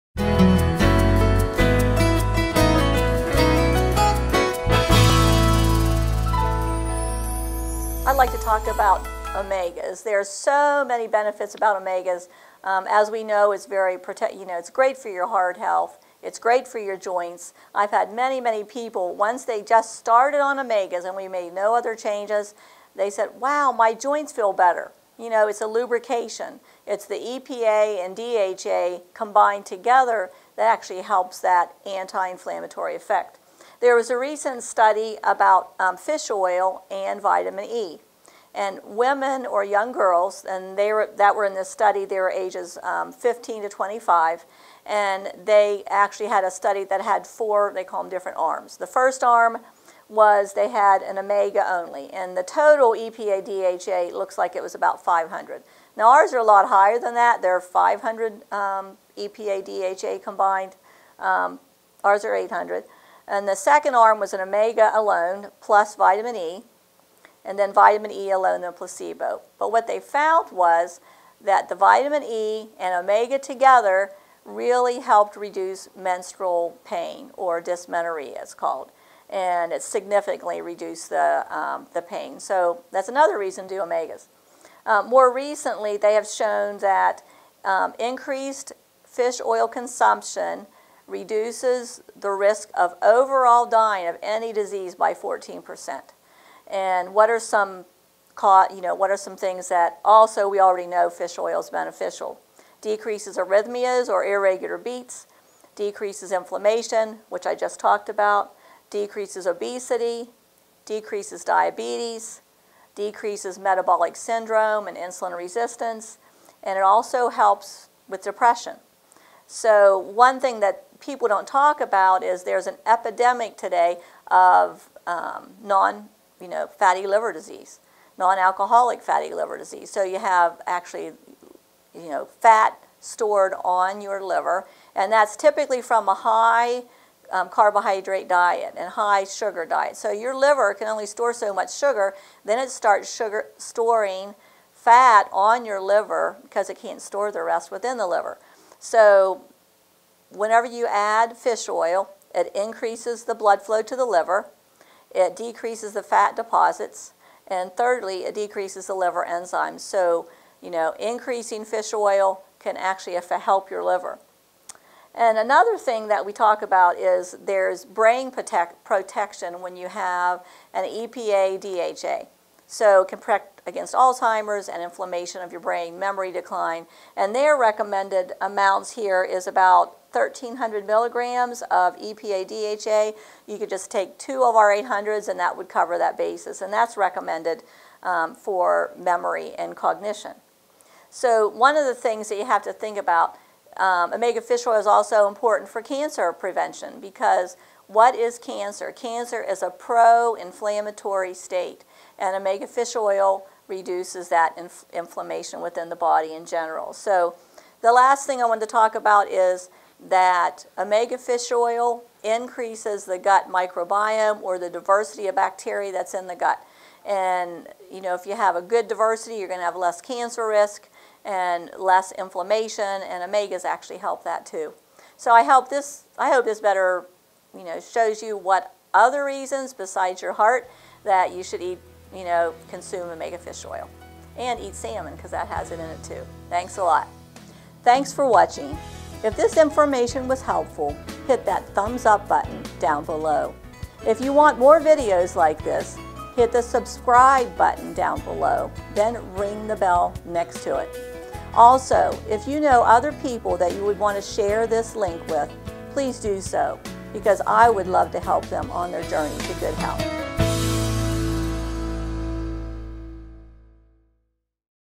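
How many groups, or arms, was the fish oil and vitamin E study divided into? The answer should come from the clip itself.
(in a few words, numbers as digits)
4.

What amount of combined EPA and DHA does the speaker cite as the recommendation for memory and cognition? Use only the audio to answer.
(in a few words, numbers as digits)
1,300 milligrams.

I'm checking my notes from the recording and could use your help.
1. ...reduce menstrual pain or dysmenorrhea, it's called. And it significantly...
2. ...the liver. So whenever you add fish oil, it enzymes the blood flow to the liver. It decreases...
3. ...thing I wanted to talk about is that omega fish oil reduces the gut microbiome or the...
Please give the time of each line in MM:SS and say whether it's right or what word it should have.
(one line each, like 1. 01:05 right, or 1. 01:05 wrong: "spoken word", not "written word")
1. 01:15 right
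2. 02:27 wrong: "increases", not "enzymes"
3. 03:28 wrong: "increases", not "reduces".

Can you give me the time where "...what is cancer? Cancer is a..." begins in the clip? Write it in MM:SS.
03:17.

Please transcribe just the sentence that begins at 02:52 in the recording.
So can protect against Alzheimer's and inflammation of your brain, memory decline.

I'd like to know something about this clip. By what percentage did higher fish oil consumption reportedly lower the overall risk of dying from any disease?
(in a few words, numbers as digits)
14 percent.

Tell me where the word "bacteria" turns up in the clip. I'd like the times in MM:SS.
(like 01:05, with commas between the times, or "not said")
03:35.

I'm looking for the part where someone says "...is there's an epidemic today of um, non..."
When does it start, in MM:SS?
02:02.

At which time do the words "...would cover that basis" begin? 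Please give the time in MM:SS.
03:05.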